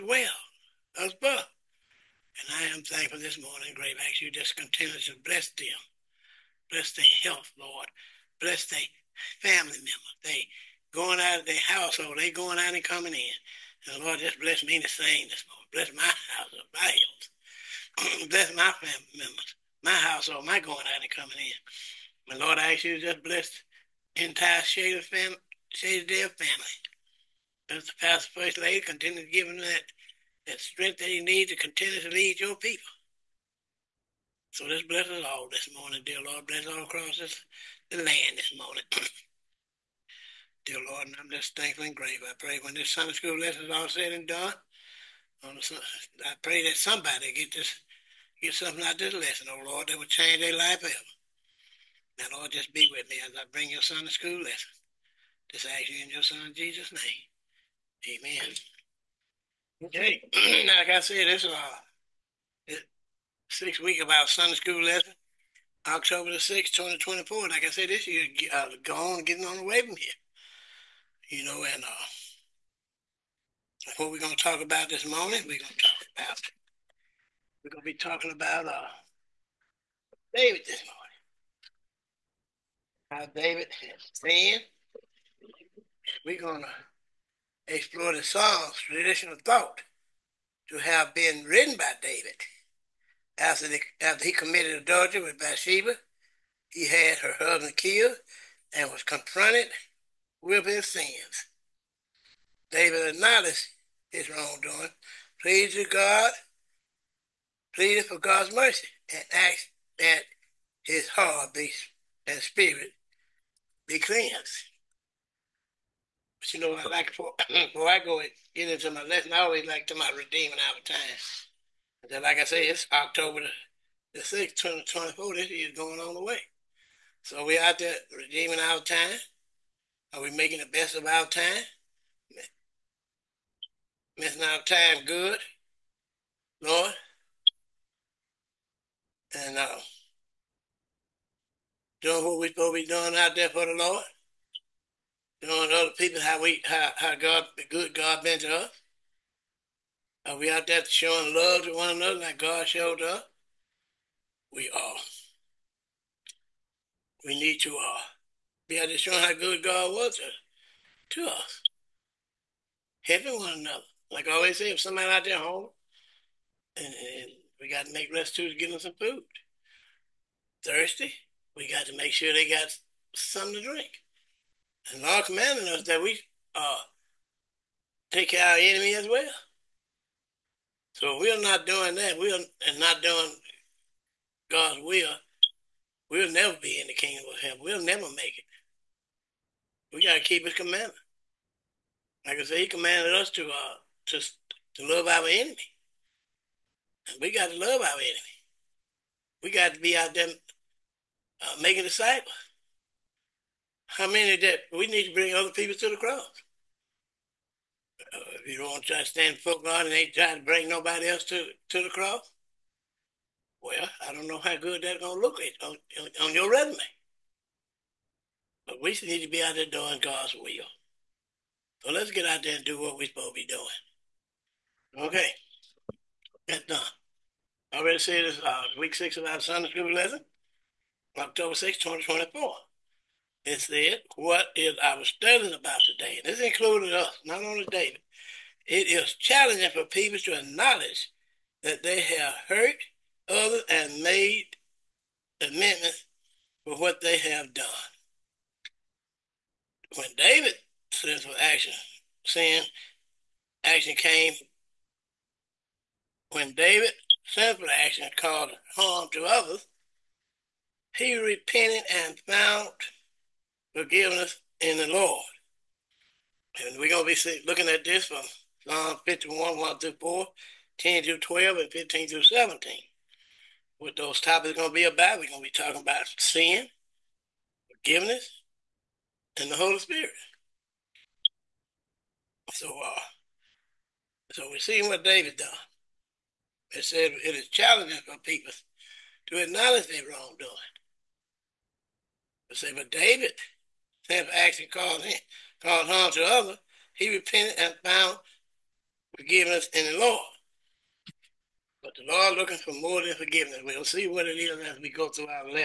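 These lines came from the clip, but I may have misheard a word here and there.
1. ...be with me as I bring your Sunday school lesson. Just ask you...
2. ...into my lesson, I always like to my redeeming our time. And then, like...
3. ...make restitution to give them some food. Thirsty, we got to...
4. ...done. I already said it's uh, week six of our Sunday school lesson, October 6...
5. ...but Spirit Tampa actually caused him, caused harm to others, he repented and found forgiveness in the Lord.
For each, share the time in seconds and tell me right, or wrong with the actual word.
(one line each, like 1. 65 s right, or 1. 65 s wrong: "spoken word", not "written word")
1. 52 s right
2. 118 s right
3. 167 s right
4. 226 s right
5. 292 s wrong: "David", not "Spirit".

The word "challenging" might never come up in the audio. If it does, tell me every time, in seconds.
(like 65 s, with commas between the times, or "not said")
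239 s, 287 s.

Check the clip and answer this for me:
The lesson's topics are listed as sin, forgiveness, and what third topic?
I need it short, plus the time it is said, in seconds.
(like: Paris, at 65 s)
the Holy Spirit, at 279 s.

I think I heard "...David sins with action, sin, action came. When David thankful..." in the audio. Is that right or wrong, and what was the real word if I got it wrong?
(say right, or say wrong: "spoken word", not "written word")
wrong: "sinful", not "thankful".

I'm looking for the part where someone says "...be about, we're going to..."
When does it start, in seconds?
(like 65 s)
274 s.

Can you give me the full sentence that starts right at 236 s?
And this included us, not only David.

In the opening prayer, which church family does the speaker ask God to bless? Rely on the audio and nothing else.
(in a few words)
Shady Dale.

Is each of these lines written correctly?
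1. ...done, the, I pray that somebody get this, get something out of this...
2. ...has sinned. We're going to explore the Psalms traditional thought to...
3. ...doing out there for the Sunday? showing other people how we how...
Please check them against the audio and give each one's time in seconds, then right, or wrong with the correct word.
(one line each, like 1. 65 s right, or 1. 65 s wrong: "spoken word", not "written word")
1. 44 s right
2. 83 s right
3. 142 s wrong: "Lord", not "Sunday".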